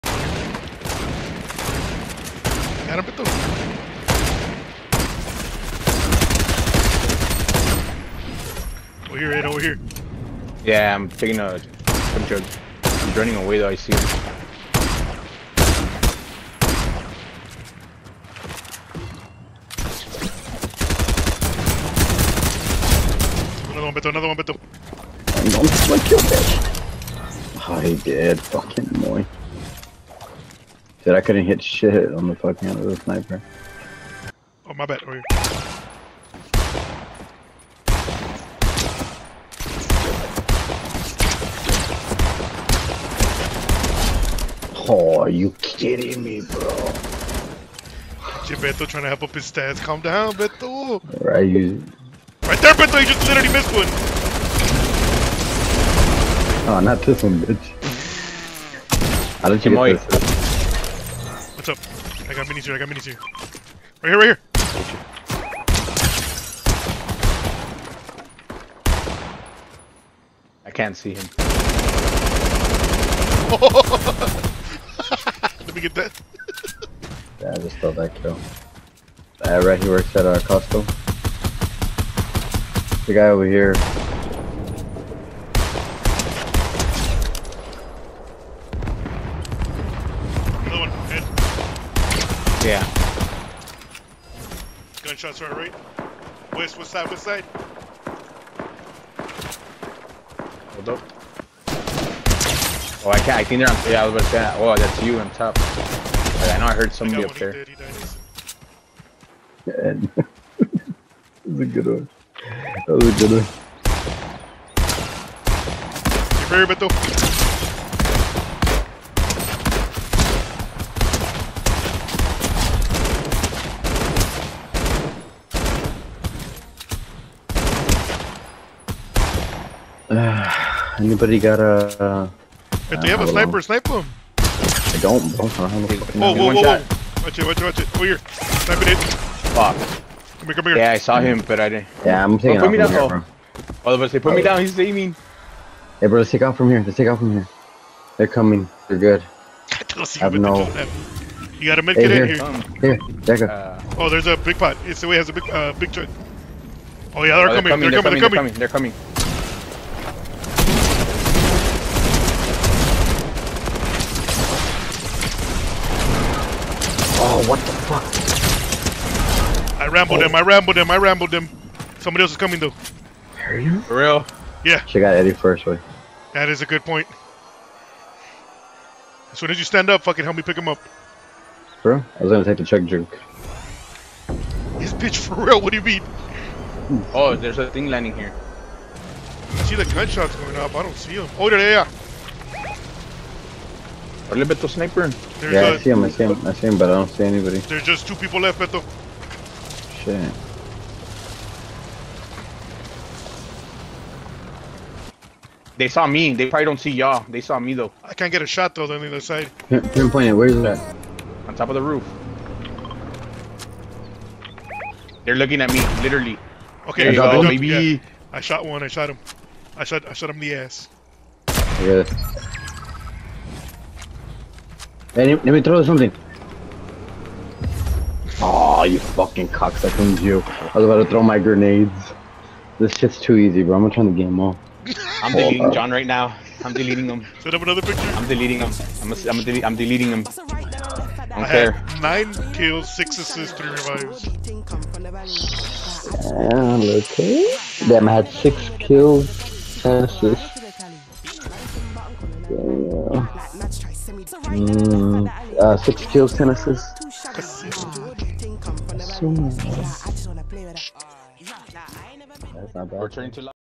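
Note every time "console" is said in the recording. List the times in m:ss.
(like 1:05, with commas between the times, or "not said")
not said.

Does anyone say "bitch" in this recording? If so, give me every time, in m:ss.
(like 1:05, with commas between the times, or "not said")
0:26, 0:57, 3:04.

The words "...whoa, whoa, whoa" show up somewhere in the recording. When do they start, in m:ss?
2:16.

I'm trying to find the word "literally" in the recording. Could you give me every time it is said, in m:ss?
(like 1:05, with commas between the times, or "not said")
0:53, 3:36.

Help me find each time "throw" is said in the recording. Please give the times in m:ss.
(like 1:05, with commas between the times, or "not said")
3:45, 3:51.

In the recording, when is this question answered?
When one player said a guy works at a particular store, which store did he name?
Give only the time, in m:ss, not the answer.
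1:20.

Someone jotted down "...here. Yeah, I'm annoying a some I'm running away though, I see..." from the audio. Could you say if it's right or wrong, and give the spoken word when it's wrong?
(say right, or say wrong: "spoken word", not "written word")
wrong: "taking", not "annoying".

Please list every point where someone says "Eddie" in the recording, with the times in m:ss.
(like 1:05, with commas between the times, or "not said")
2:55.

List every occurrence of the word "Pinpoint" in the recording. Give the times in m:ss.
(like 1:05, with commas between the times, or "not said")
3:29.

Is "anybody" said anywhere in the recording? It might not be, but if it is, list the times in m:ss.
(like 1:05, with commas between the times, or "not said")
2:10, 3:17.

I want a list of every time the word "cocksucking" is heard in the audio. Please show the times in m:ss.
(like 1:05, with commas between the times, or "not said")
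3:49.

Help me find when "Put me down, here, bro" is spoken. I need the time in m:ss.
2:22.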